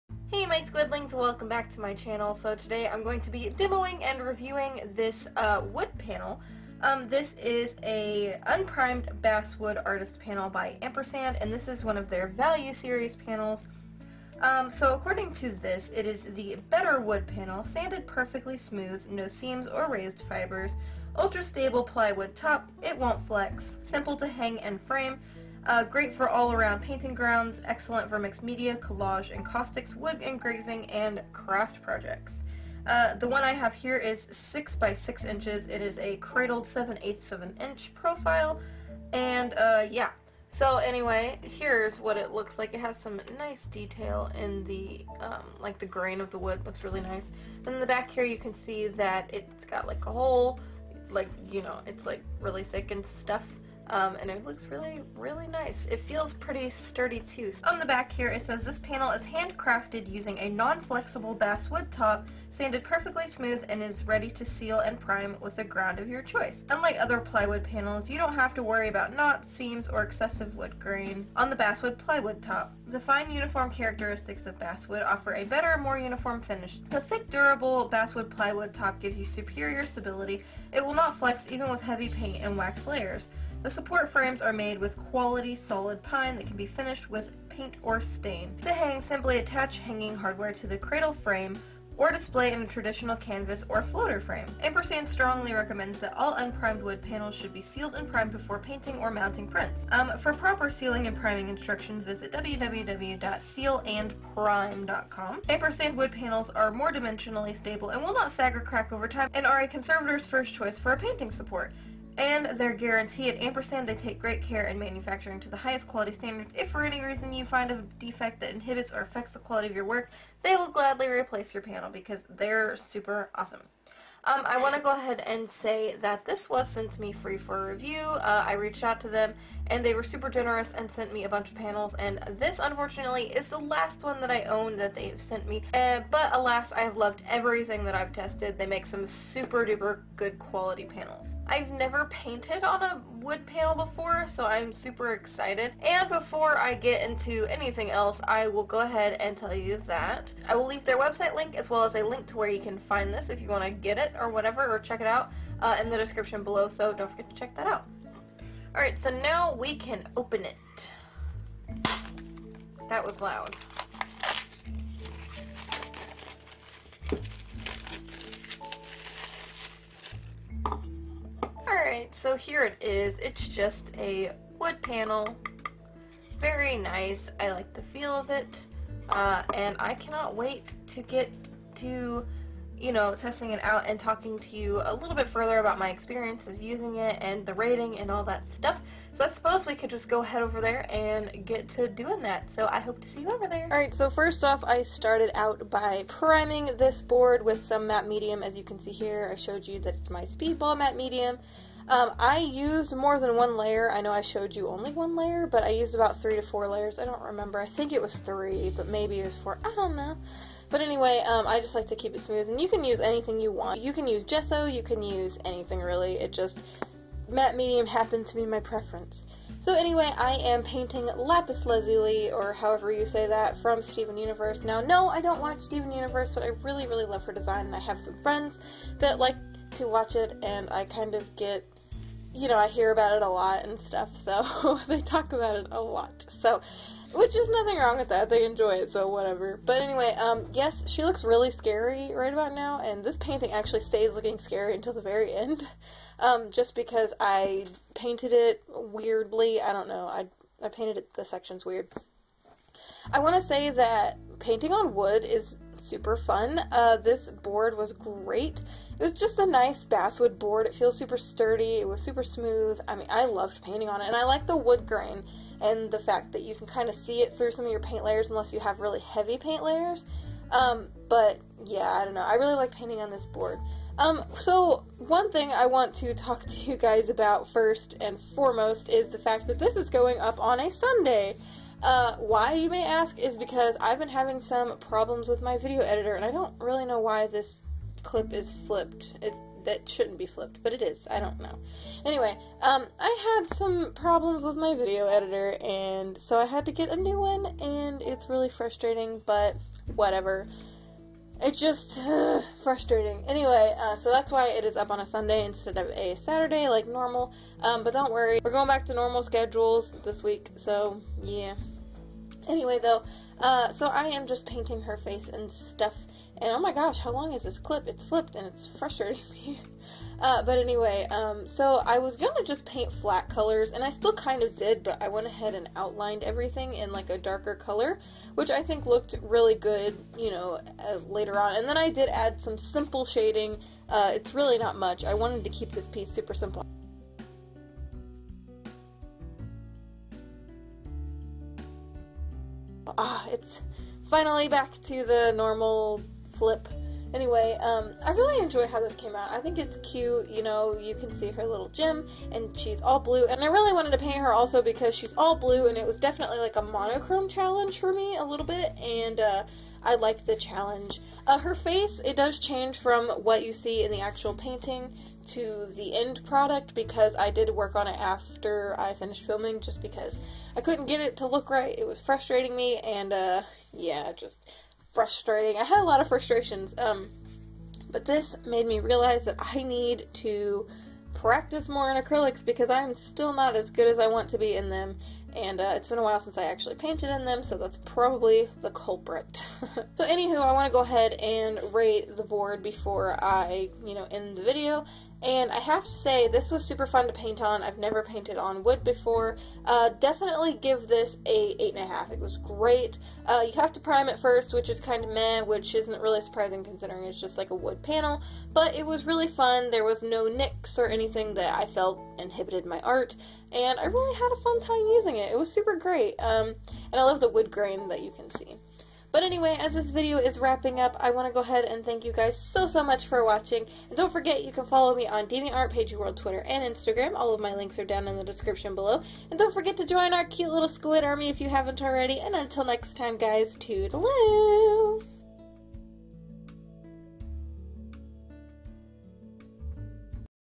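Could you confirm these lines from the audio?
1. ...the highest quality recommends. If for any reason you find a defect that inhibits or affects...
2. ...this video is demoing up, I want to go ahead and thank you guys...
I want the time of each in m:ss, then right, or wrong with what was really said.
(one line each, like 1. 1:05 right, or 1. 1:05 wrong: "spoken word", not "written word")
1. 1:55 wrong: "standards", not "recommends"
2. 6:59 wrong: "wrapping", not "demoing".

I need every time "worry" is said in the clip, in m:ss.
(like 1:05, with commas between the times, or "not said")
1:08, 5:08.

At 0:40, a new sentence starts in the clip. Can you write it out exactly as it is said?
So anyway, here's what it looks like.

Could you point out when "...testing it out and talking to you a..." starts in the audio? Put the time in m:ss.
3:03.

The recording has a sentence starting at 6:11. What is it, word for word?
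It was frustrating me, and uh, yeah, just frustrating.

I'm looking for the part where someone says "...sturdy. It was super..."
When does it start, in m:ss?
4:21.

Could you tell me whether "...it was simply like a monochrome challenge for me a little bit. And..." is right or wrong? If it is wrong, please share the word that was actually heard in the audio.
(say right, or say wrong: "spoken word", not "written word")
wrong: "definitely", not "simply".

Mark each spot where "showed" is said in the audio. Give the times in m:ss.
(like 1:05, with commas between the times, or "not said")
3:19, 3:24.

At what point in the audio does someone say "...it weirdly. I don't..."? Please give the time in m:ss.
4:08.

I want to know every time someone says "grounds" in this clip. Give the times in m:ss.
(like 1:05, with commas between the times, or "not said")
0:27, 1:05.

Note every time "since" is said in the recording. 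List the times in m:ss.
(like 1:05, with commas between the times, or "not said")
6:26.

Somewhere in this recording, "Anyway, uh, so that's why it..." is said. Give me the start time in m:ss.
5:03.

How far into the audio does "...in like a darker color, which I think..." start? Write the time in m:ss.
5:26.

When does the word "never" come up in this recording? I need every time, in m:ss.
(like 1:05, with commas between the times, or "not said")
2:21, 6:37.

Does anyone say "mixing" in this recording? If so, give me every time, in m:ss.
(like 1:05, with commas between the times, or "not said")
not said.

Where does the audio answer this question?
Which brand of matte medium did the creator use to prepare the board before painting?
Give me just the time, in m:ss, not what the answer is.
3:20.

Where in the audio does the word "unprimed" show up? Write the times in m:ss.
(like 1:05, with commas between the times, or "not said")
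0:08, 1:36.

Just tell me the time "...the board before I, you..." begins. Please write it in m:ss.
6:32.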